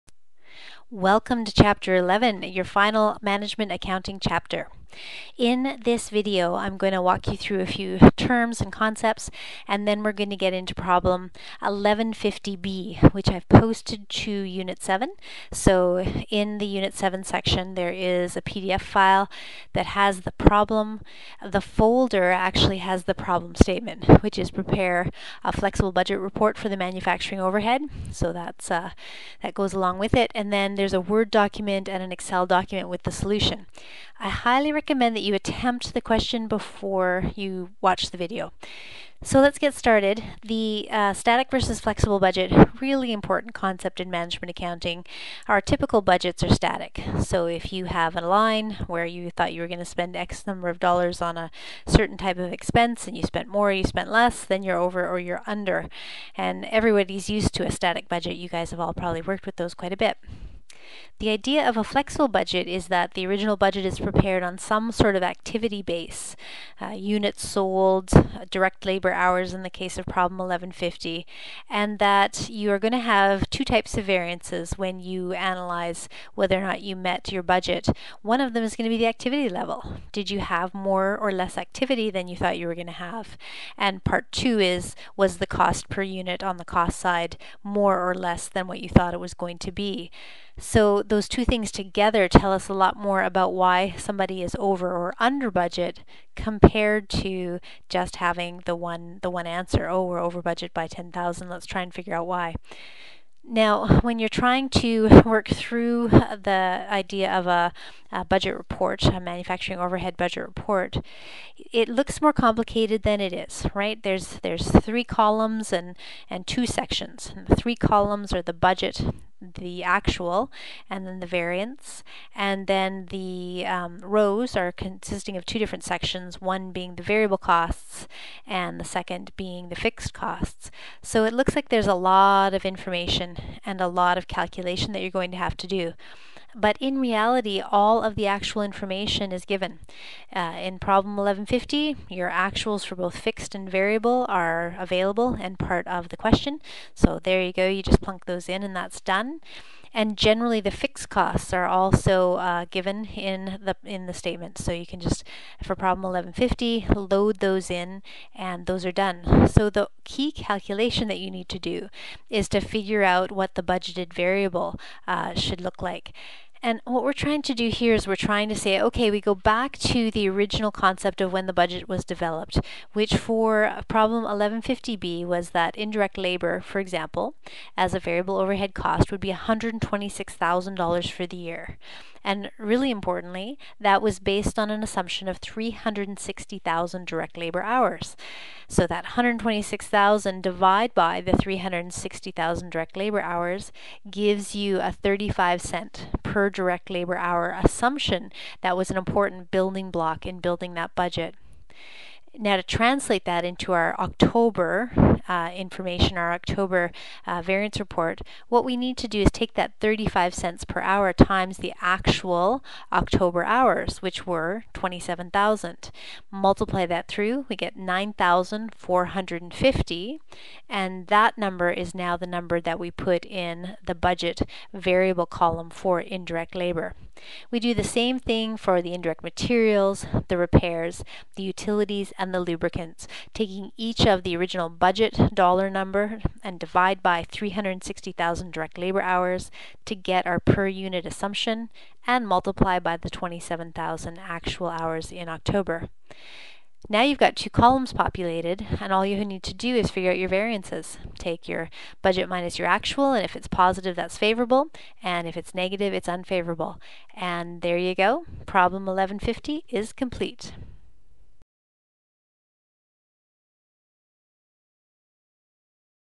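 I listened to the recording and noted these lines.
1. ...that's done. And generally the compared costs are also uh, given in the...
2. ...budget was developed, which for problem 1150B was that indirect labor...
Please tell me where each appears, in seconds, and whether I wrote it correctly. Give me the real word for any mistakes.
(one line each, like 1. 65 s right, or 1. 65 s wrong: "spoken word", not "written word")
1. 148 s wrong: "fixed", not "compared"
2. 171 s right.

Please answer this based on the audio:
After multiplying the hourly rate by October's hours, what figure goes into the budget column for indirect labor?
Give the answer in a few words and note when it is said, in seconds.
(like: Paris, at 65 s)
9,450, at 217 s.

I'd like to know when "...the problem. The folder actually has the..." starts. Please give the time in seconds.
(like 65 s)
20 s.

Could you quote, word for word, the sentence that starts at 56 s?
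And everybody's used to a static budget.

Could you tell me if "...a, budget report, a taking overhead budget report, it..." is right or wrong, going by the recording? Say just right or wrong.
wrong.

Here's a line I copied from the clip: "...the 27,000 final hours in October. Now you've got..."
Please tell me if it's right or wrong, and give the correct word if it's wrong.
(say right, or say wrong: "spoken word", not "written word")
wrong: "actual", not "final".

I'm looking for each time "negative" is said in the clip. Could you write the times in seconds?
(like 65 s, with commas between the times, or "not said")
255 s.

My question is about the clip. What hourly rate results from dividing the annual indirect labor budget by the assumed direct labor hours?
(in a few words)
35 cents.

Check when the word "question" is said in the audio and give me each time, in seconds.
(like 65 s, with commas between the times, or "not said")
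36 s, 146 s.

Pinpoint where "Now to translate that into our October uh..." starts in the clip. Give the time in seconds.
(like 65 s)
202 s.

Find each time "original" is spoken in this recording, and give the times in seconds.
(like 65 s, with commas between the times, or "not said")
63 s, 170 s, 234 s.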